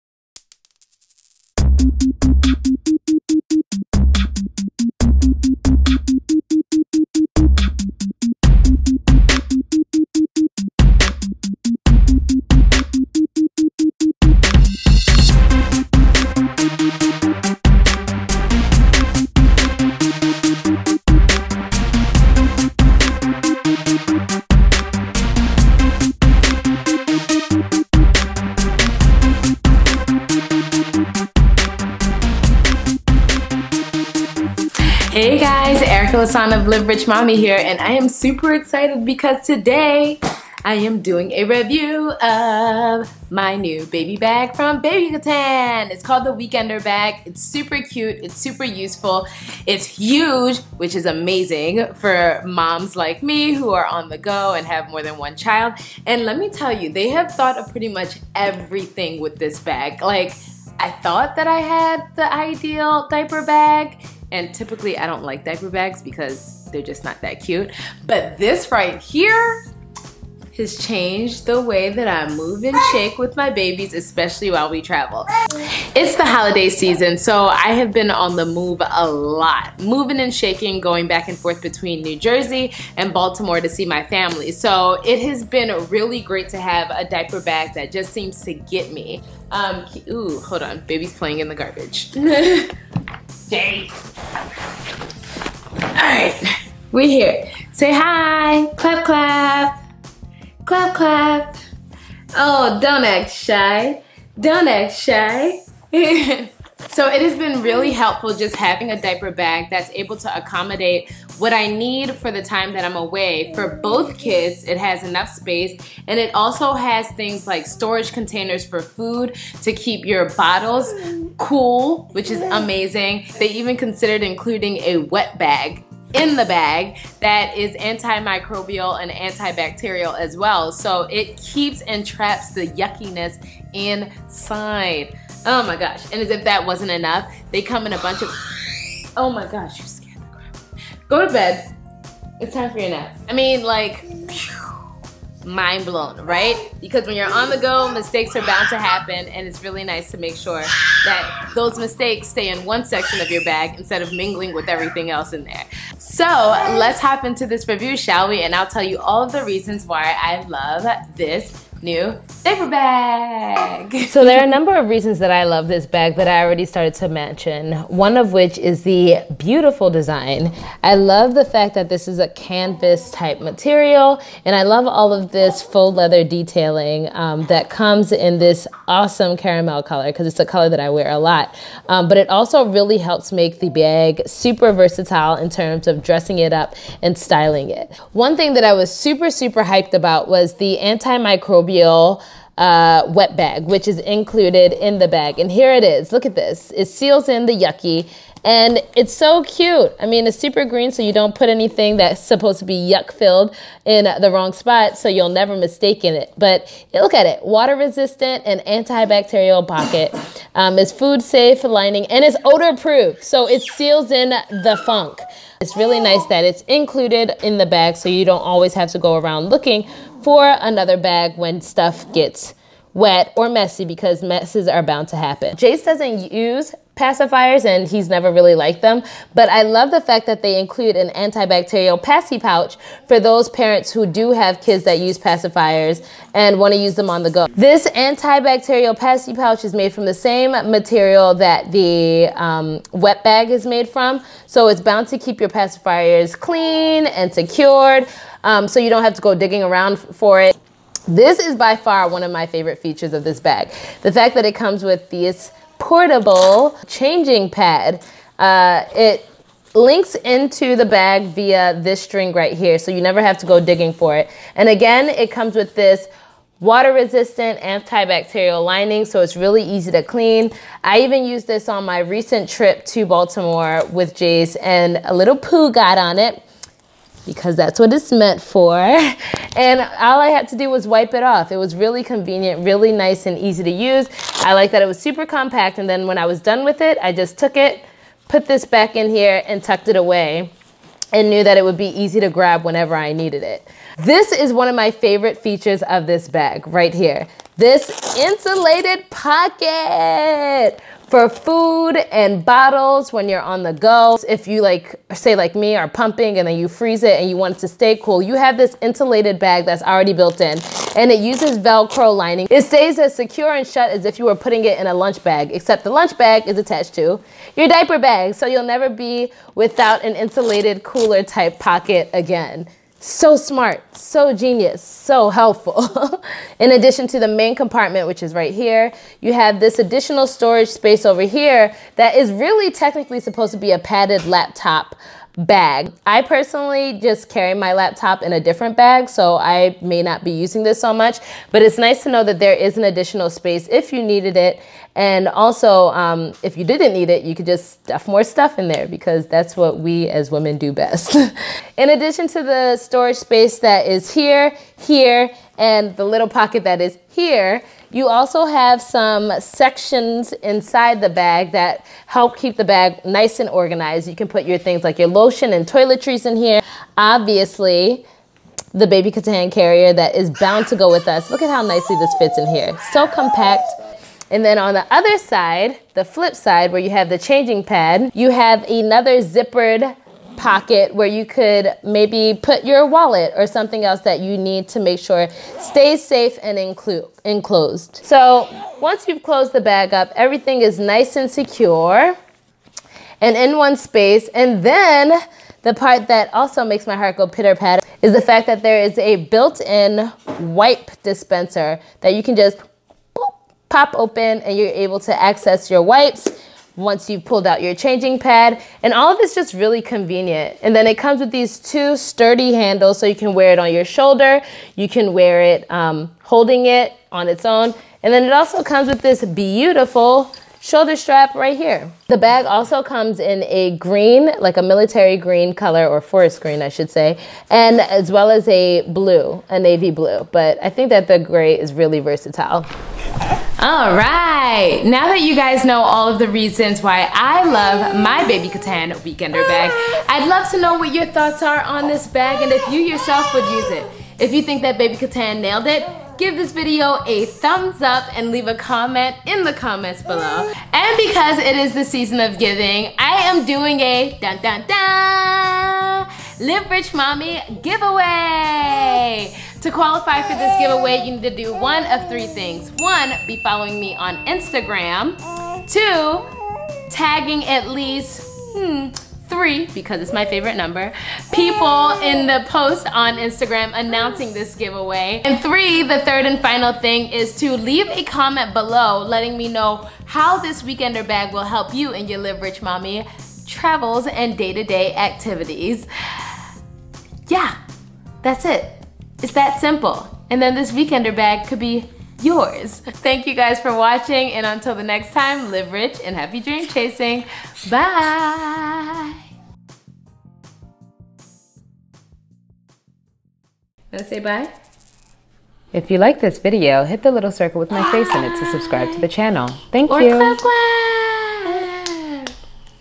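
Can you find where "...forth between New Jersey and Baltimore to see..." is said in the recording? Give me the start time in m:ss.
1:21.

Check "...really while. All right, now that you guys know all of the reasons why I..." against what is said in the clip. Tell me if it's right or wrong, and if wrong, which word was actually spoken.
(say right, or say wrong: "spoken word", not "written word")
wrong: "versatile", not "while".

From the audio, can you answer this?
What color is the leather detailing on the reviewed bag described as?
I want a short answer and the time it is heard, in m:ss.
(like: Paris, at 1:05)
caramel, at 2:59.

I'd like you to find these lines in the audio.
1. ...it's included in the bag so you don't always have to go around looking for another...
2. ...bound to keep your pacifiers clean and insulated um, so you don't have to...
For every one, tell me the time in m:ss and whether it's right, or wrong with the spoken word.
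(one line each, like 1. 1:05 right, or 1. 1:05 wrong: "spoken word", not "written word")
1. 3:36 right
2. 4:04 wrong: "secured", not "insulated".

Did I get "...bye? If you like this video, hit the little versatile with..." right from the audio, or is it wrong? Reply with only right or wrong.
wrong.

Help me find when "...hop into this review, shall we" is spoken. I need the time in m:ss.
2:37.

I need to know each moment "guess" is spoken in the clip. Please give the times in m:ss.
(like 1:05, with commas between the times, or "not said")
not said.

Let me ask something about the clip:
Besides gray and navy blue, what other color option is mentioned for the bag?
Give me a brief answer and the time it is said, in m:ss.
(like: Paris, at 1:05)
forest green, at 7:06.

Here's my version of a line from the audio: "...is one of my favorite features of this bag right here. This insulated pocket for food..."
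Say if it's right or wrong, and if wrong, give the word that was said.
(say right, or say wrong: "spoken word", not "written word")
right.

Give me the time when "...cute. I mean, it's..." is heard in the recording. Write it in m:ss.
3:19.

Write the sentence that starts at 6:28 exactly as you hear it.
So once you've closed the bag up, everything is nice and secure and in one space.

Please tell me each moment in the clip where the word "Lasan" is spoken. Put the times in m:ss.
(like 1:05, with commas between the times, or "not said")
0:36.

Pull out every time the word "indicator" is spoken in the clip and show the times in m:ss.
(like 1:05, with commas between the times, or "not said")
not said.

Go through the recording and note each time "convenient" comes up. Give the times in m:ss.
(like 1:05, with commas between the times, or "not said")
4:42, 6:49.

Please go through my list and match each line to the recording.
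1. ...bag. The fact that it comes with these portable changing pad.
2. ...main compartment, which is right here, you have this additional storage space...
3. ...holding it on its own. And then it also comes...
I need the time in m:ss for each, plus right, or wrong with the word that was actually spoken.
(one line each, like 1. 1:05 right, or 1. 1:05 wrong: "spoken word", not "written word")
1. 4:13 right
2. 5:27 right
3. 6:56 right.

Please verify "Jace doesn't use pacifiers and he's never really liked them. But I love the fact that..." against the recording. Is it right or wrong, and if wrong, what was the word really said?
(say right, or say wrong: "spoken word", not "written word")
right.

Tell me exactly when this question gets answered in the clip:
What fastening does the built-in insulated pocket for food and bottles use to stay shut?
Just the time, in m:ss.
5:11.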